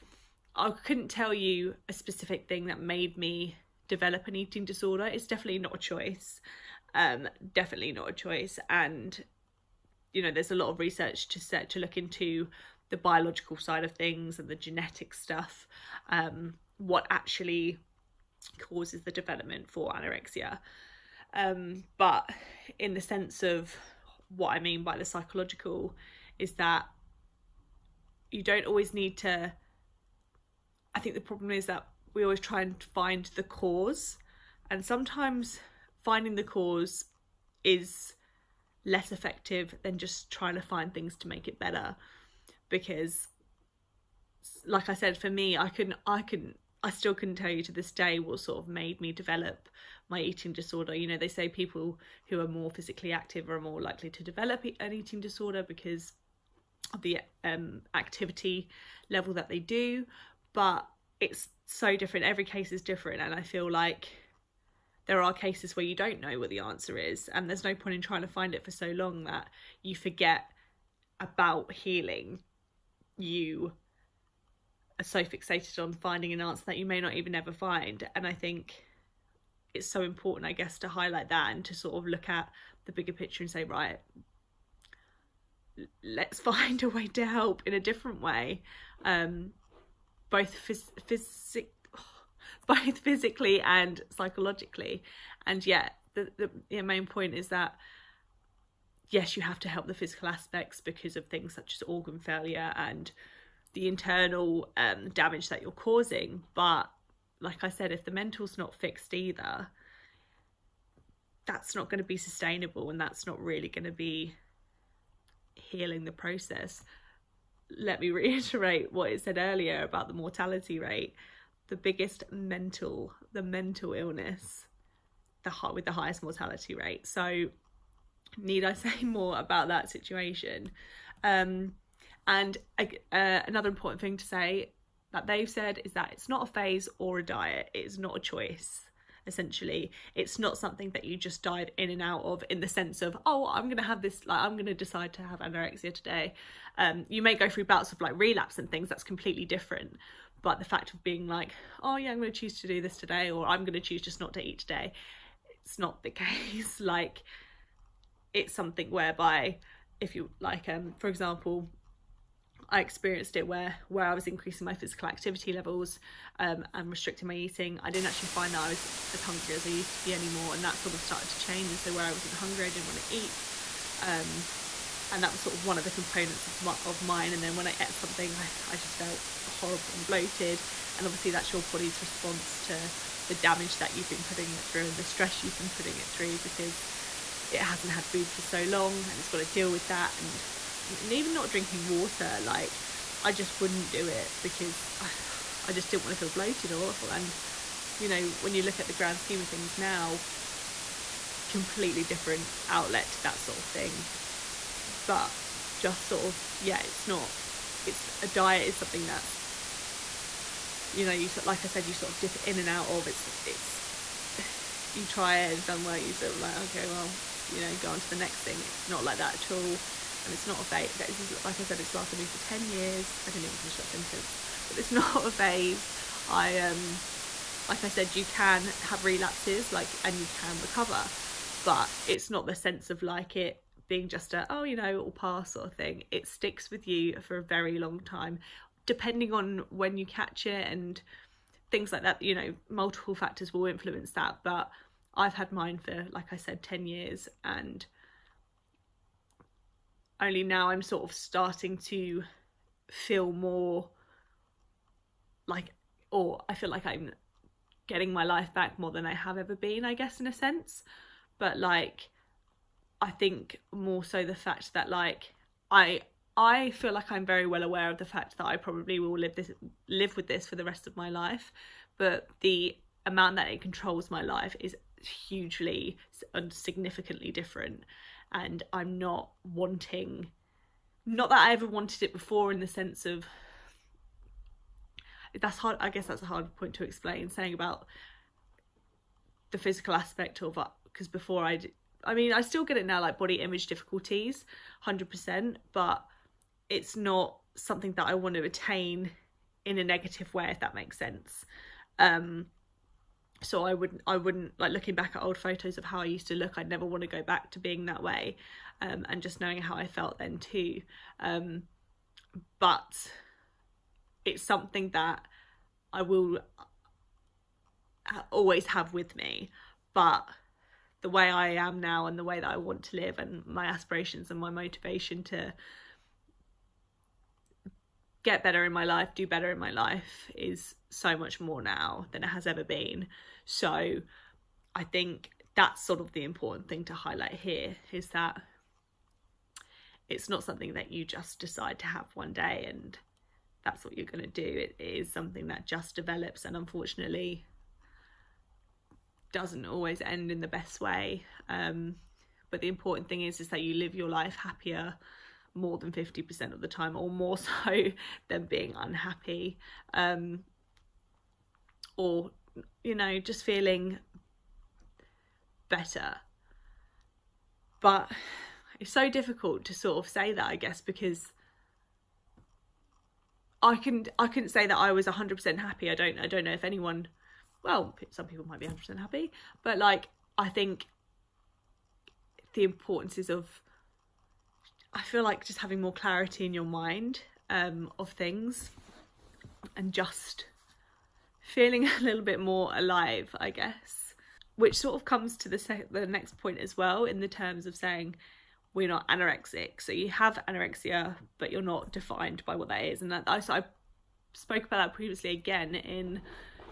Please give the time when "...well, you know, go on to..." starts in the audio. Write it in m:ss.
3:36.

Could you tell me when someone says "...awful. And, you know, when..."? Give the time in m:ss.
3:16.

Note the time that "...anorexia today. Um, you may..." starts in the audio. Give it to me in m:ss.
2:25.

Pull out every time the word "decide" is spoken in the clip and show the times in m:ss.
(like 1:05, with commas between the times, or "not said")
2:24, 5:41.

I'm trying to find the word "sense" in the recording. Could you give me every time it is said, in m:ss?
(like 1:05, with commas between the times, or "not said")
0:22, 2:22, 3:52, 4:20, 4:42, 5:00.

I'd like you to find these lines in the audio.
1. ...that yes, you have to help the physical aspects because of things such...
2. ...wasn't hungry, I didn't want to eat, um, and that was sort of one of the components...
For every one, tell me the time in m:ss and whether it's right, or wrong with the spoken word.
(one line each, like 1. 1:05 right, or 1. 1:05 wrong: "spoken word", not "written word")
1. 1:37 right
2. 2:52 right.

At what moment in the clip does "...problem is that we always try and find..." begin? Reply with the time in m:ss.
0:31.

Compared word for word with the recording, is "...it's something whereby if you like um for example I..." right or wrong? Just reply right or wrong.
right.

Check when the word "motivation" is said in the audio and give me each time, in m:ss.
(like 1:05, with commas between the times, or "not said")
5:24.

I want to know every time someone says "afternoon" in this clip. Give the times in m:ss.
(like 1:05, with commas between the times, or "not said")
not said.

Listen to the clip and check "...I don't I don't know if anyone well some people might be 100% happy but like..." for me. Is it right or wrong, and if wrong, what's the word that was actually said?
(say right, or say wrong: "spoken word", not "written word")
right.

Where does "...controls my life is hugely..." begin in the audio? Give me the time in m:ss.
4:33.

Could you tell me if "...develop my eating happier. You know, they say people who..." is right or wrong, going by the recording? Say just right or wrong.
wrong.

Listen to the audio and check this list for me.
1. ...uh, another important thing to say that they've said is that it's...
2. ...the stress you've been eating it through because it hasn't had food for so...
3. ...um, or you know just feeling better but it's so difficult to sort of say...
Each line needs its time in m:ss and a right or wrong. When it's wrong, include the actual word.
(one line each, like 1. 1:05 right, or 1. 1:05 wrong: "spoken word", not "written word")
1. 2:12 right
2. 3:04 wrong: "putting", not "eating"
3. 5:59 right.